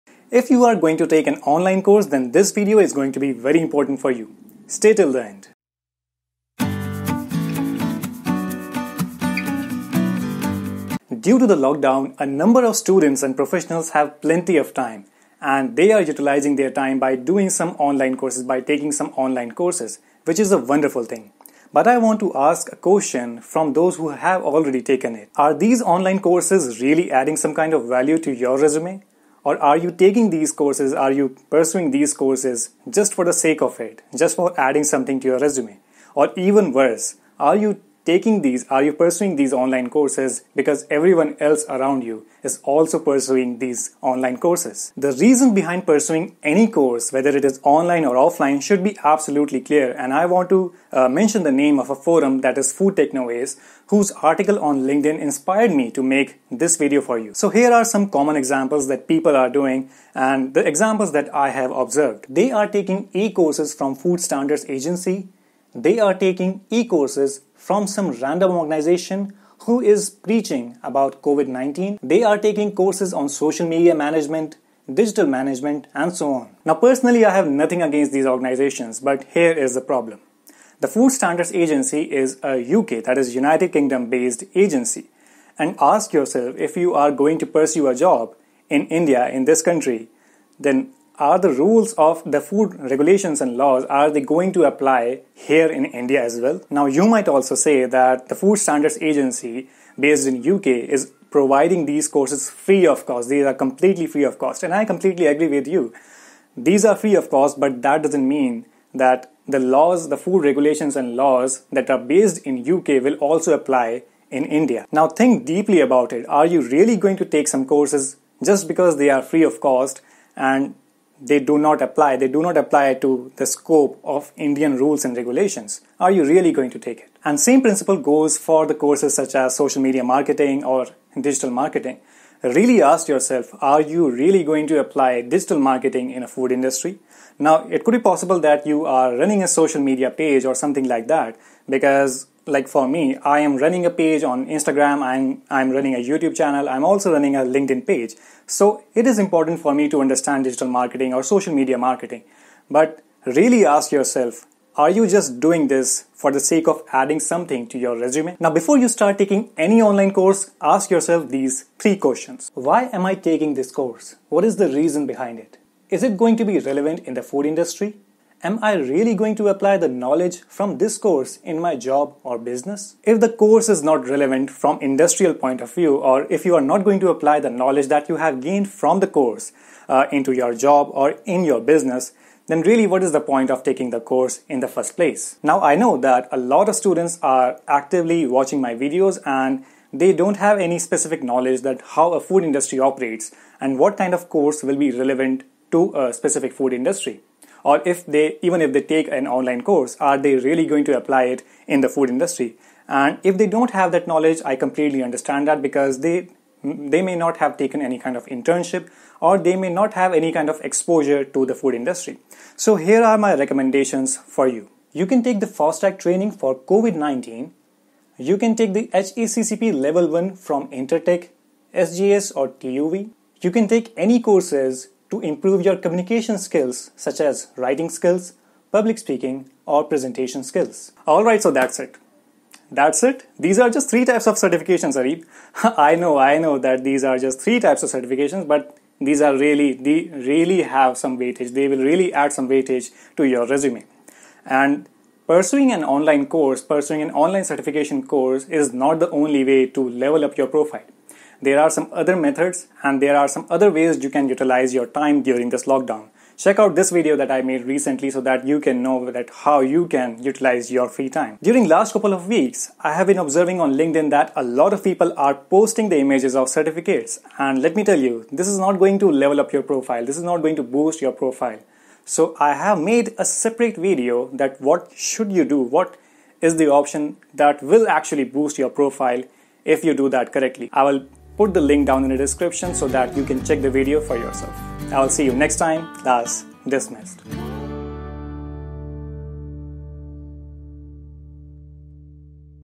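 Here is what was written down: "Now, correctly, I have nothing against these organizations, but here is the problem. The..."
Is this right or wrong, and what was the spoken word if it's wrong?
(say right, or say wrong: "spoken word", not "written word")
wrong: "personally", not "correctly".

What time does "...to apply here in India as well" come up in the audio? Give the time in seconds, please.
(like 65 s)
94 s.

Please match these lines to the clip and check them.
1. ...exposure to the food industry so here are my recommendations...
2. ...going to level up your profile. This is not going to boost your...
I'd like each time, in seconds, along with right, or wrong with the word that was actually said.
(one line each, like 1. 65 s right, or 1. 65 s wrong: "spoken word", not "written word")
1. 210 s right
2. 268 s right.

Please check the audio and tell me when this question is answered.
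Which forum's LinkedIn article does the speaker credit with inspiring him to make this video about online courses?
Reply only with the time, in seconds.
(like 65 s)
52 s.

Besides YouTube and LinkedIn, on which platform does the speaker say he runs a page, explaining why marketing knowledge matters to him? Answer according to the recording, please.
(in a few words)
Instagram.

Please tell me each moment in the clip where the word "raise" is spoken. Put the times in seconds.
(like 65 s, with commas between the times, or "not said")
not said.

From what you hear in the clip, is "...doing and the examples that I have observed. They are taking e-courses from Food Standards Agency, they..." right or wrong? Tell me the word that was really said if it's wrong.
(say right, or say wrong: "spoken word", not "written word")
right.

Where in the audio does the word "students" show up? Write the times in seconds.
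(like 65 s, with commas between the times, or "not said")
12 s, 186 s.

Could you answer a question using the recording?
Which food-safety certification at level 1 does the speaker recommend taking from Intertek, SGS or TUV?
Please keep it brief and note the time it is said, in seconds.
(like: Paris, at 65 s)
HACCP, at 218 s.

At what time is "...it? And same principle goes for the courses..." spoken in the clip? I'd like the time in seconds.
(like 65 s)
127 s.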